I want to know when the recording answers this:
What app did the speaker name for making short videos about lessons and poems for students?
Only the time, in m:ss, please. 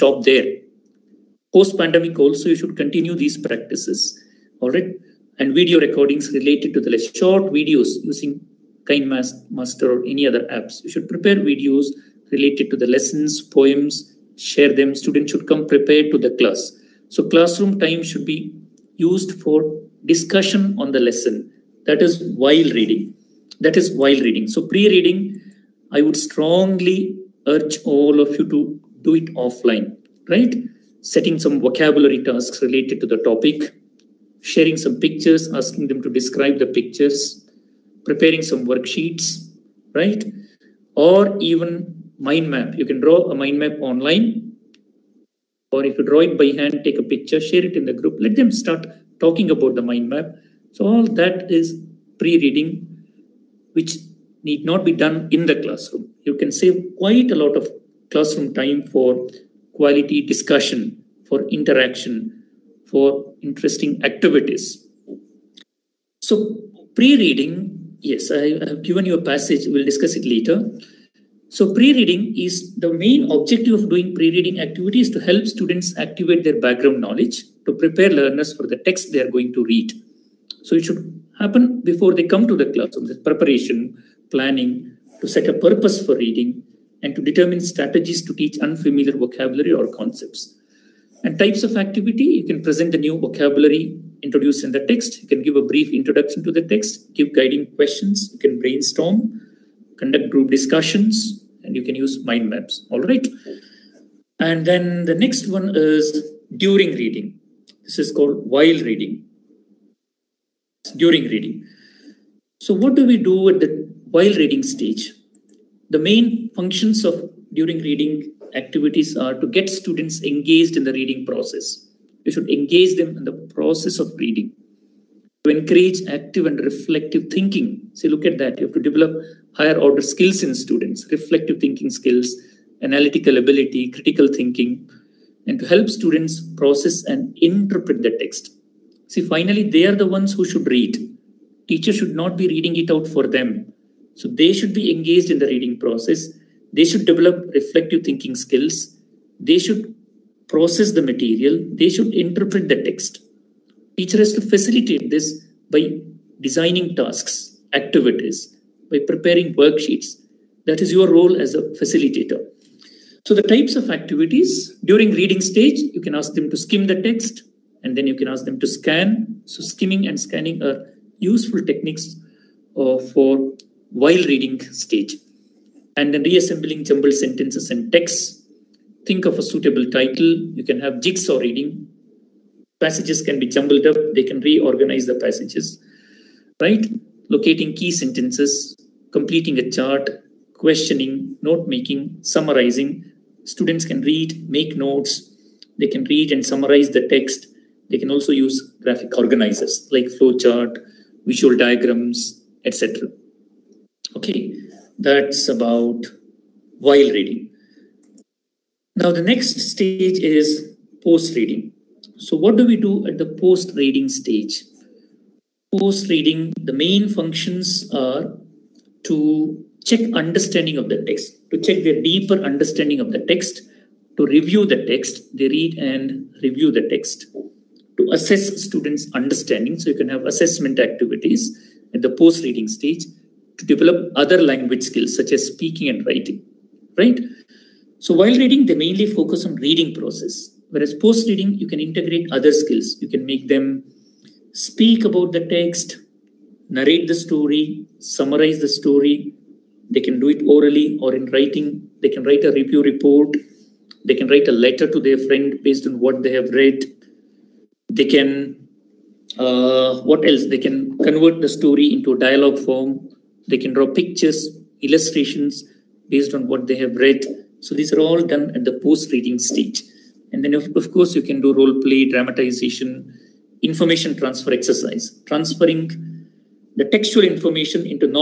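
0:09.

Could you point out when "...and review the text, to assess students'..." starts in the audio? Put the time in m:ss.
3:45.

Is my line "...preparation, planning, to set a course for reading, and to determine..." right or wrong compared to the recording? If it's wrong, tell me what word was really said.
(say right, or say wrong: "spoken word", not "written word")
wrong: "purpose", not "course".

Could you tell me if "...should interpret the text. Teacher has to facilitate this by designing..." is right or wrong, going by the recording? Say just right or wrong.
right.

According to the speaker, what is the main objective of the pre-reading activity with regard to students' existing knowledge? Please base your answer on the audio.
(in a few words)
activate their background knowledge.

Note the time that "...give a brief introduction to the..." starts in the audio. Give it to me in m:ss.
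1:35.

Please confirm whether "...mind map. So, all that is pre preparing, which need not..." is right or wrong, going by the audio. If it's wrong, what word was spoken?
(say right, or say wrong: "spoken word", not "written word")
wrong: "reading", not "preparing".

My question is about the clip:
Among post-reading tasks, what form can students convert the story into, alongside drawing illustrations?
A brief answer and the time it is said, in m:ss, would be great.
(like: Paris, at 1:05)
dialogue form, at 4:22.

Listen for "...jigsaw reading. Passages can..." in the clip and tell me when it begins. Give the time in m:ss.
3:01.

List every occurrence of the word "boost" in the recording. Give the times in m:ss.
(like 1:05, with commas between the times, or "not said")
not said.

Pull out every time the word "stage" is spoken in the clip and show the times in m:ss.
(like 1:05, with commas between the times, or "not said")
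1:54, 2:45, 2:54, 3:29, 3:34, 3:52, 4:29.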